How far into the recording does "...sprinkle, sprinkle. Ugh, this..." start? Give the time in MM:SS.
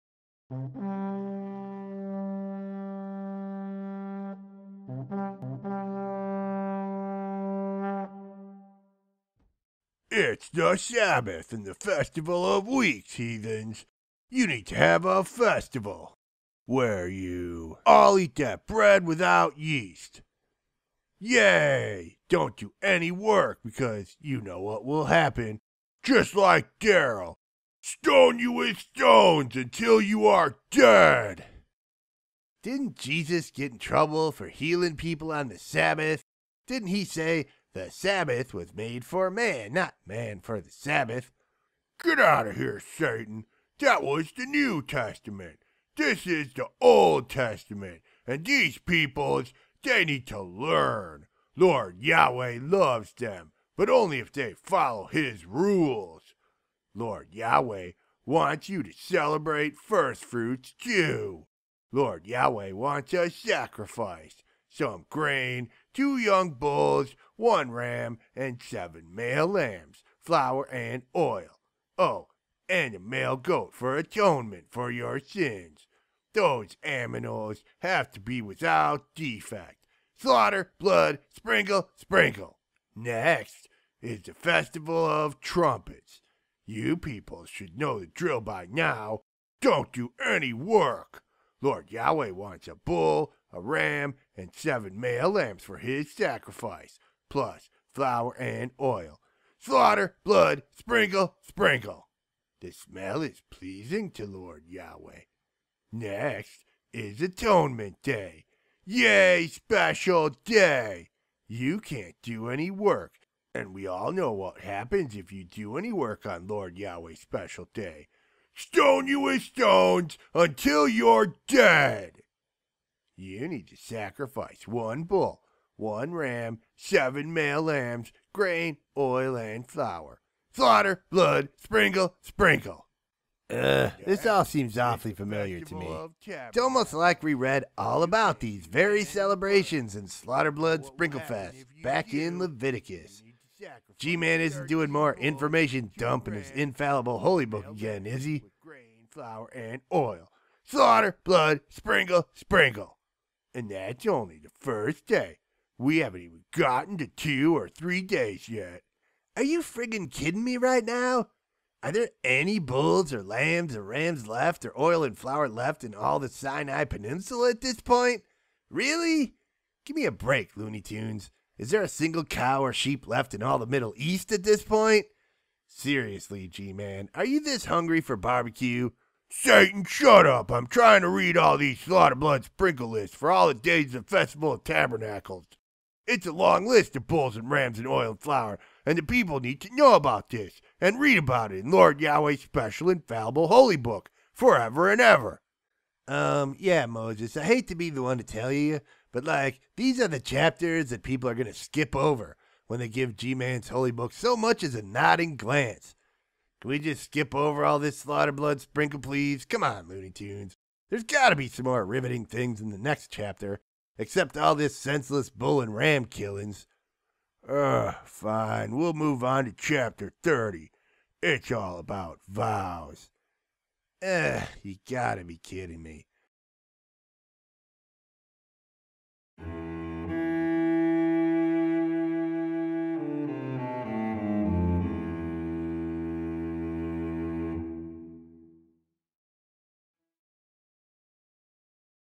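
02:11.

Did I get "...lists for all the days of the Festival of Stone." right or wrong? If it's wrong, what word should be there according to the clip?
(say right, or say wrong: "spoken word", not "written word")
wrong: "Tabernacles", not "Stone".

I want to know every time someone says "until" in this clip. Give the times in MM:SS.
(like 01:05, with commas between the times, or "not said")
00:29, 02:00.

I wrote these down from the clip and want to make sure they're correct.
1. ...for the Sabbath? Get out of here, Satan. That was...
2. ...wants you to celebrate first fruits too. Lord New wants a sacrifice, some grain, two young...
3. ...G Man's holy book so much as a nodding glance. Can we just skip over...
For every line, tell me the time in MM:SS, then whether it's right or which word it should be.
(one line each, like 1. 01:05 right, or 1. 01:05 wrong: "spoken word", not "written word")
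1. 00:40 right
2. 00:58 wrong: "Yahweh", not "New"
3. 03:23 right.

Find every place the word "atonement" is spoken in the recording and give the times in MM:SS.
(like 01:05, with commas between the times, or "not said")
01:13, 01:47.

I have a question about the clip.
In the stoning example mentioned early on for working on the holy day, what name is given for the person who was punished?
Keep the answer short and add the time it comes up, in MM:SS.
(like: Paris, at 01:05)
Daryl, at 00:26.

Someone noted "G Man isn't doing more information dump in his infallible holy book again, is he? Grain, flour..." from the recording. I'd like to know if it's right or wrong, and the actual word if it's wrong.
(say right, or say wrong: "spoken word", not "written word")
right.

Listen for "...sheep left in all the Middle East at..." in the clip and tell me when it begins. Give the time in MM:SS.
02:52.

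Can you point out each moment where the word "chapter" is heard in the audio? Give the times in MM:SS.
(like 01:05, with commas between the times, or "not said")
03:20, 03:33, 03:39.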